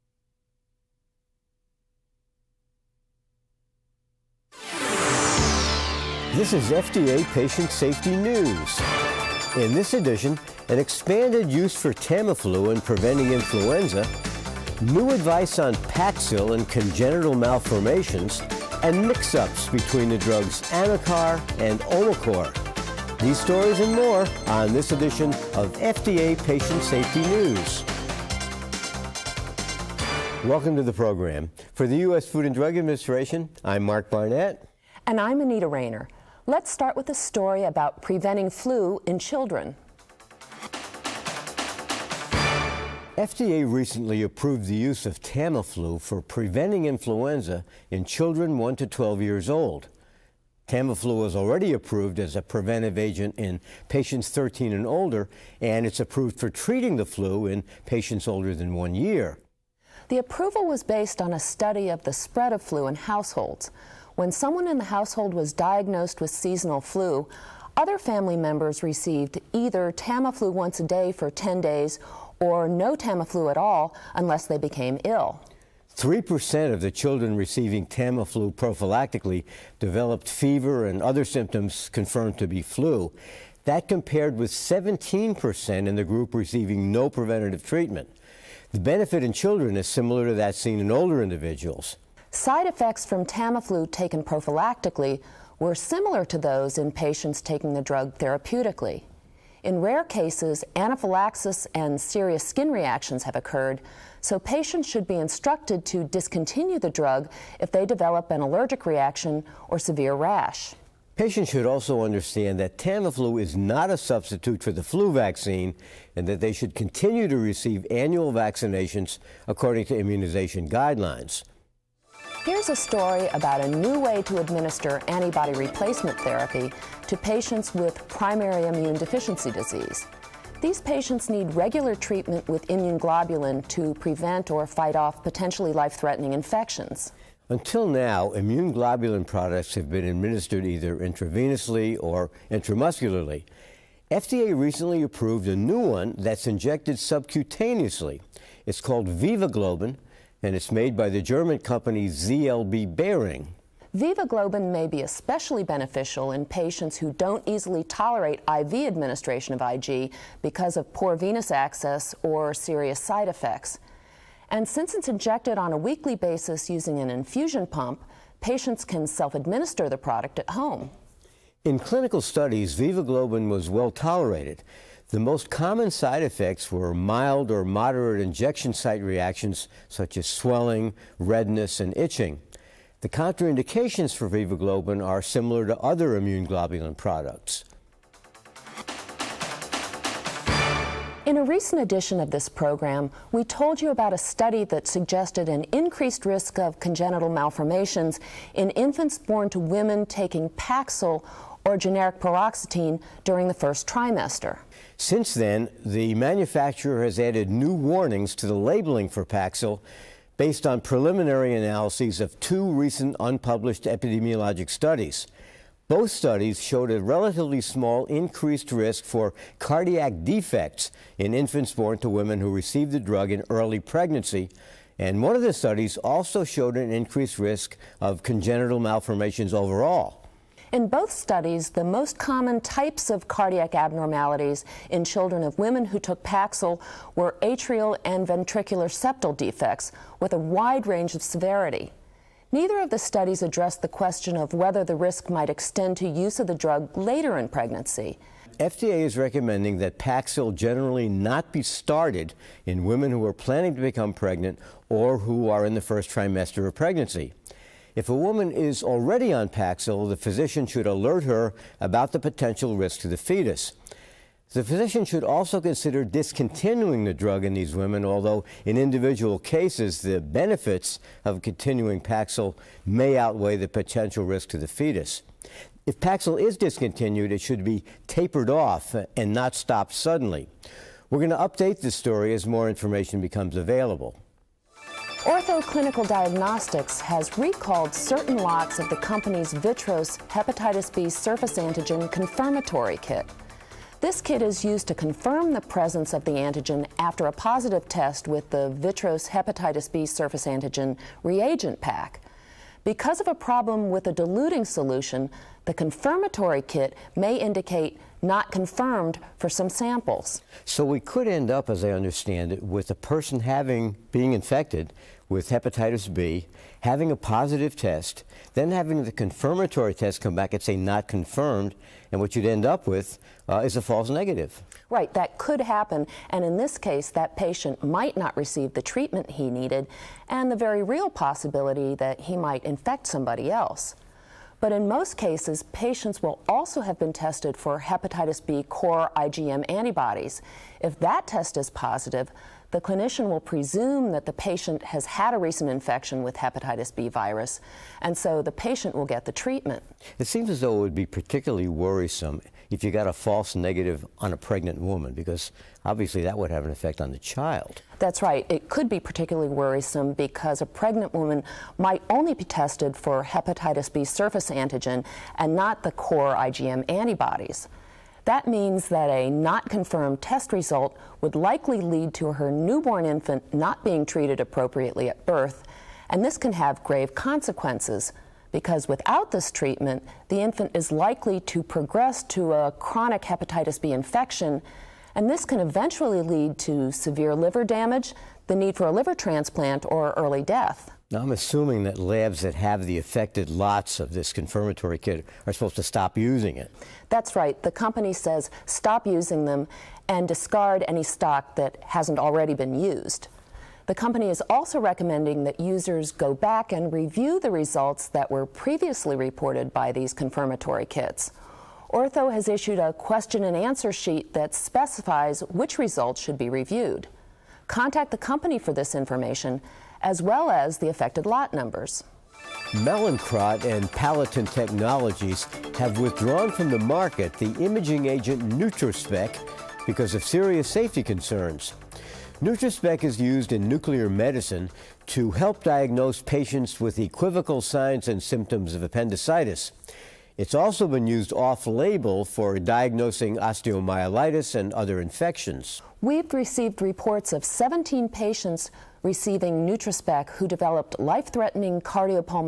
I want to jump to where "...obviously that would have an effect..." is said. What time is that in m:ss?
5:55.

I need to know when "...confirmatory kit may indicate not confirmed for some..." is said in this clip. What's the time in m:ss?
5:05.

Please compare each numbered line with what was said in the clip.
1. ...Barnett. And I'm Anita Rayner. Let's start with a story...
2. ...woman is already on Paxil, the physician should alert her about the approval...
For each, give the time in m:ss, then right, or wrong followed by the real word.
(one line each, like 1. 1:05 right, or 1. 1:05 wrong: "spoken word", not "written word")
1. 0:34 right
2. 4:18 wrong: "potential", not "approval".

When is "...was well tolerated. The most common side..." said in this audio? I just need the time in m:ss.
2:53.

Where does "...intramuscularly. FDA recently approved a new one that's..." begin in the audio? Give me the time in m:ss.
2:22.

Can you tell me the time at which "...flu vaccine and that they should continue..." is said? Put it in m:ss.
1:54.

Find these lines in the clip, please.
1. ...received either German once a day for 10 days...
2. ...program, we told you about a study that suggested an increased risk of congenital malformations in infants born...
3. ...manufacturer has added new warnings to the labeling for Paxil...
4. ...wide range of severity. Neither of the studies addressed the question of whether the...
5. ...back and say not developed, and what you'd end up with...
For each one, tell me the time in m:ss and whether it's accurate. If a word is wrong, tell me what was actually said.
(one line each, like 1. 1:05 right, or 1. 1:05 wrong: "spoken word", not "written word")
1. 1:08 wrong: "Tamiflu", not "German"
2. 3:12 right
3. 3:26 right
4. 4:00 right
5. 5:20 wrong: "confirmed", not "developed".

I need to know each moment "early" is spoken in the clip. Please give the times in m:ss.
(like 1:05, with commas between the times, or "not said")
3:43, 6:30.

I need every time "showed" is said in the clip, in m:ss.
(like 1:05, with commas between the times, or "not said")
3:36, 3:46.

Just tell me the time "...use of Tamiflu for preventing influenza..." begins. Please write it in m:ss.
0:44.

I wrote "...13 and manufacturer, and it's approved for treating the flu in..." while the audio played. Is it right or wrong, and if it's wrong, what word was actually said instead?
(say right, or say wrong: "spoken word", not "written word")
wrong: "older", not "manufacturer".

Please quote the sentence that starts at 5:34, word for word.
But in most cases, patients will also have been tested for hepatitis B core IgM antibodies.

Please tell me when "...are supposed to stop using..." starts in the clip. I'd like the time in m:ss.
6:35.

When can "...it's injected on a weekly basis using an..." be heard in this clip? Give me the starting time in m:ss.
2:44.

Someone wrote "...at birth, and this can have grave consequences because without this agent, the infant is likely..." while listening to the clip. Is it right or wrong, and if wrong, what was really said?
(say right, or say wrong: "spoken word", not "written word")
wrong: "treatment", not "agent".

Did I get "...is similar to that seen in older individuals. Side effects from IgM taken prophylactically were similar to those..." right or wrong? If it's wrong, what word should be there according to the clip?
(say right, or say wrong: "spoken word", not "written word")
wrong: "Tamiflu", not "IgM".